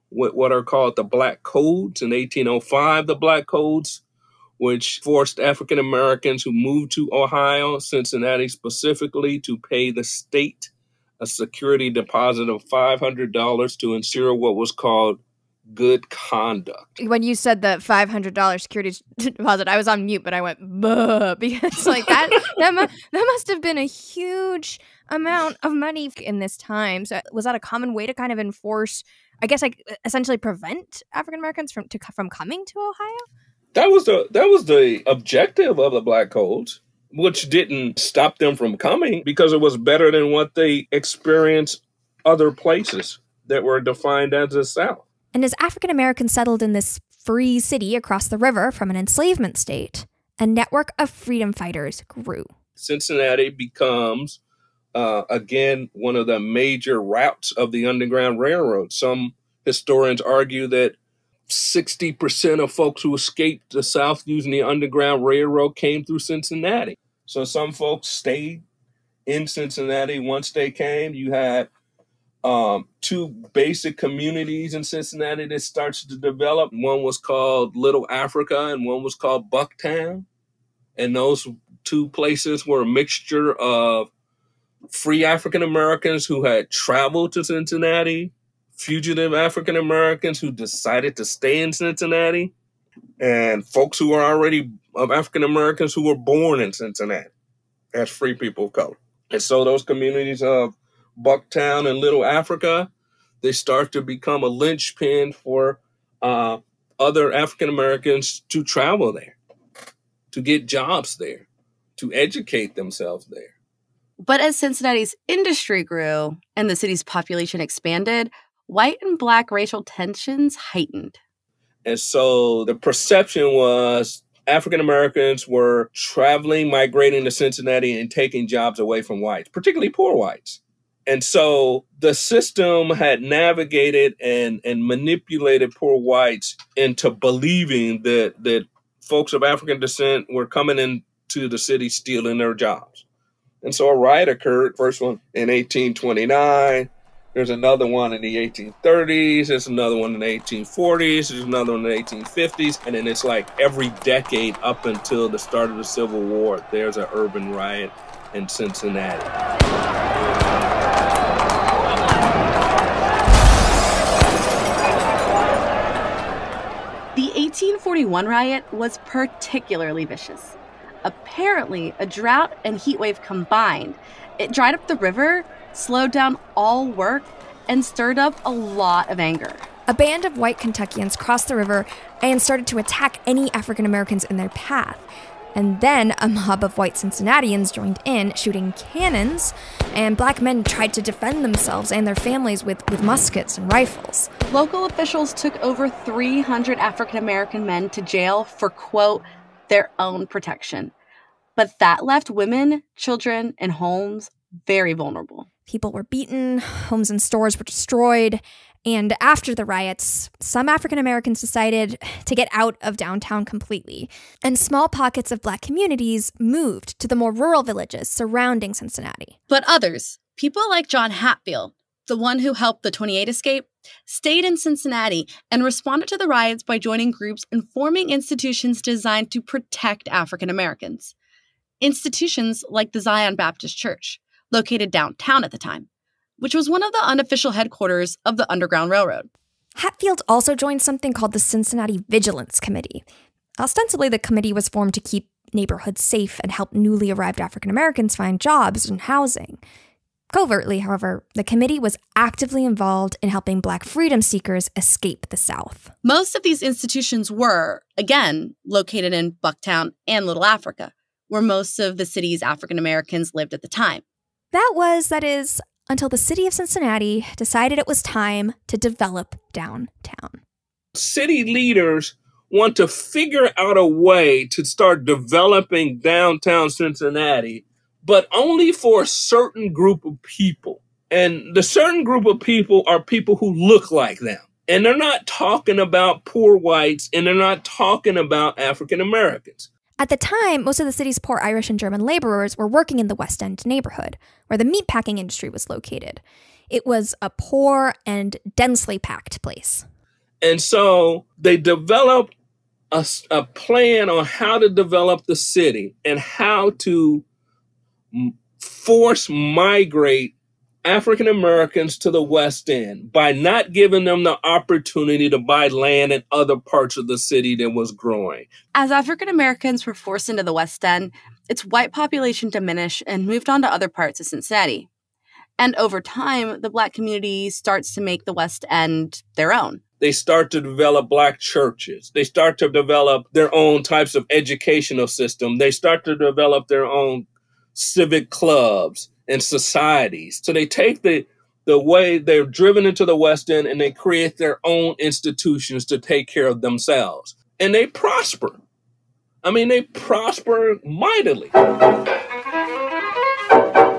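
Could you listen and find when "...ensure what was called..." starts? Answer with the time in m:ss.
0:13.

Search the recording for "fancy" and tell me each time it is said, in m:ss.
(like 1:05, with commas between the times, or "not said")
not said.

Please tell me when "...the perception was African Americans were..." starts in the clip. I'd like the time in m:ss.
2:02.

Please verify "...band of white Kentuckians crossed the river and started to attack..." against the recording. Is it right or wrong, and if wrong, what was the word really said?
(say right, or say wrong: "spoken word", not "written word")
right.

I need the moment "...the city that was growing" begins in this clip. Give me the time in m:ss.
5:17.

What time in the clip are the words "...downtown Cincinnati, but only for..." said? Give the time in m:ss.
4:35.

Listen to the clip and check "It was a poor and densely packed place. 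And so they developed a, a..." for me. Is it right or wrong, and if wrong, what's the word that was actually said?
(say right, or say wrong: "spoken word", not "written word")
right.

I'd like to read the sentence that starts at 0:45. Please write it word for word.
And as African Americans settled in this free city across the river from an enslavement state, a network of freedom fighters grew.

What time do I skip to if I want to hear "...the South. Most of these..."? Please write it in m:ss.
4:15.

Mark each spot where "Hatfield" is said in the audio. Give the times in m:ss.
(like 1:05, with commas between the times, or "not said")
3:41, 3:59.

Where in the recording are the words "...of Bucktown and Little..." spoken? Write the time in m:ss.
1:40.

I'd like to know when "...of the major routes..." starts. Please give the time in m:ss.
0:56.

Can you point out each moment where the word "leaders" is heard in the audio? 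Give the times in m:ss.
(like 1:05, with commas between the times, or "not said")
4:31.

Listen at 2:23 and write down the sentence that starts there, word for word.
And so a riot occurred, first one in 1829.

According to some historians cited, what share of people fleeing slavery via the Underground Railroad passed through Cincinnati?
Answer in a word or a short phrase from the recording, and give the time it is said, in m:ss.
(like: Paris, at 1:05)
60%, at 1:01.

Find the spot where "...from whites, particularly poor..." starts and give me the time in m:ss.
2:09.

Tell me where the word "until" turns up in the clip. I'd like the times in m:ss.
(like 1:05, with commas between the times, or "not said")
2:34, 4:25.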